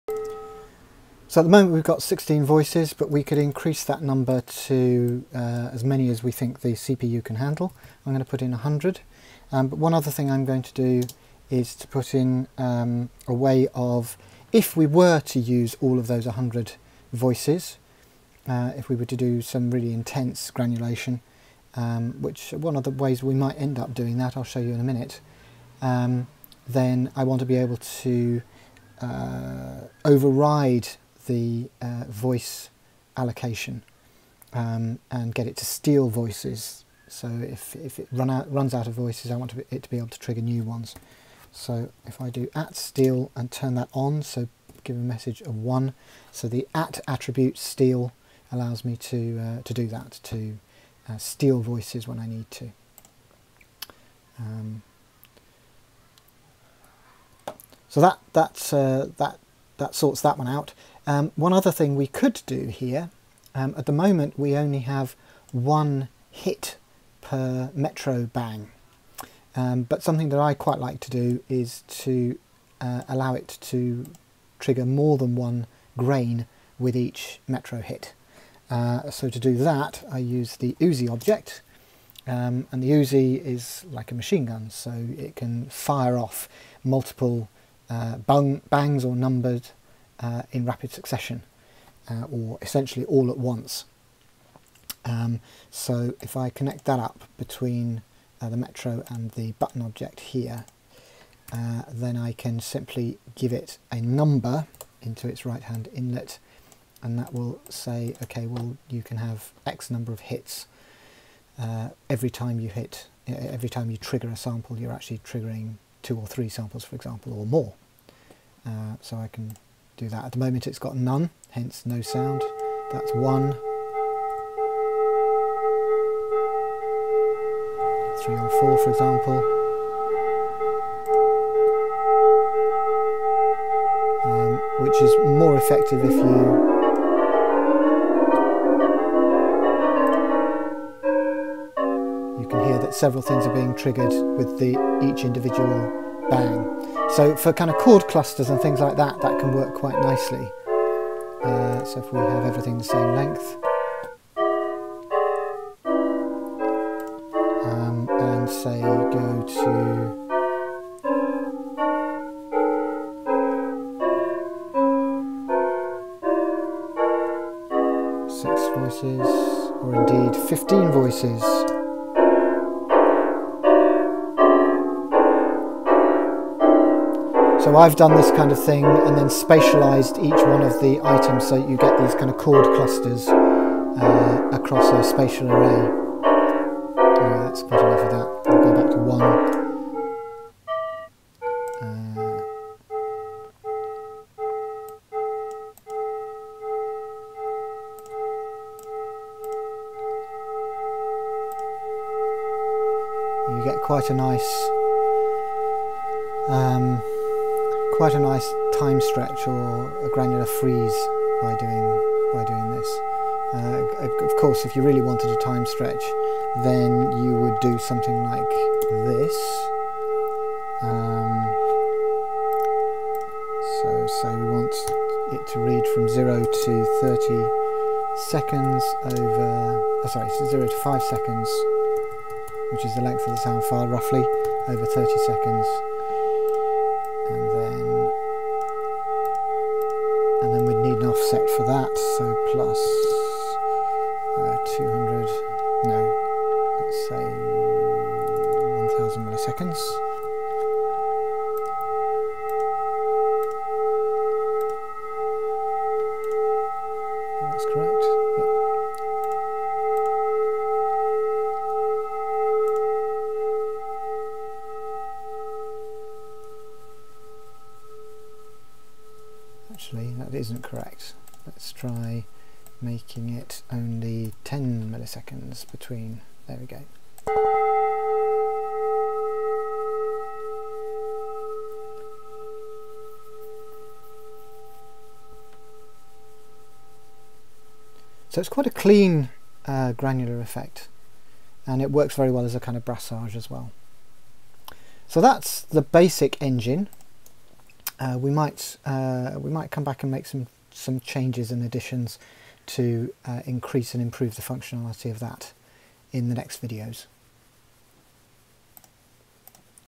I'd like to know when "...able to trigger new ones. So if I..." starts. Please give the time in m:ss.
0:39.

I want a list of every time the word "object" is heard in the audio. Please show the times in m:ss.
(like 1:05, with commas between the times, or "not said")
1:21, 1:39.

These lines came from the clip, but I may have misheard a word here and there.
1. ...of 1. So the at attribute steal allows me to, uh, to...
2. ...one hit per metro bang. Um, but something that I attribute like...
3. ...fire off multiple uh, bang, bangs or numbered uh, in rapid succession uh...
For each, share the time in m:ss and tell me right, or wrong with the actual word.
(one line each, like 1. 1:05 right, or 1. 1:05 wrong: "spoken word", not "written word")
1. 0:45 right
2. 1:05 wrong: "quite", not "attribute"
3. 1:25 right.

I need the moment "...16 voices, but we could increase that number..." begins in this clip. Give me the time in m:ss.
0:02.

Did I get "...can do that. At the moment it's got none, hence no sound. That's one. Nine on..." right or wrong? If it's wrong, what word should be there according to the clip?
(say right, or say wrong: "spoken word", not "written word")
wrong: "Three", not "Nine".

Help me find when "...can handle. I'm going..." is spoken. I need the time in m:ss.
0:07.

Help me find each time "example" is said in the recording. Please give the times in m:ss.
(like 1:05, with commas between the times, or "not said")
1:56, 2:08.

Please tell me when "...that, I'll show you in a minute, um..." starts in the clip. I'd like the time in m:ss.
0:24.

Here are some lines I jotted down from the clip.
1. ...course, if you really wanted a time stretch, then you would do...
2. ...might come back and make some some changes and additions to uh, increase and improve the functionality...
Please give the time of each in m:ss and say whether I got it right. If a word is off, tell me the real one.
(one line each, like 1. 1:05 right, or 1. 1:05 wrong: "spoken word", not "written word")
1. 3:34 right
2. 4:59 right.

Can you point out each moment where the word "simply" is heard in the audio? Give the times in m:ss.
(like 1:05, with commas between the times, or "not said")
1:42.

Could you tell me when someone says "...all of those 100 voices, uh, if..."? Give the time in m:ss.
0:15.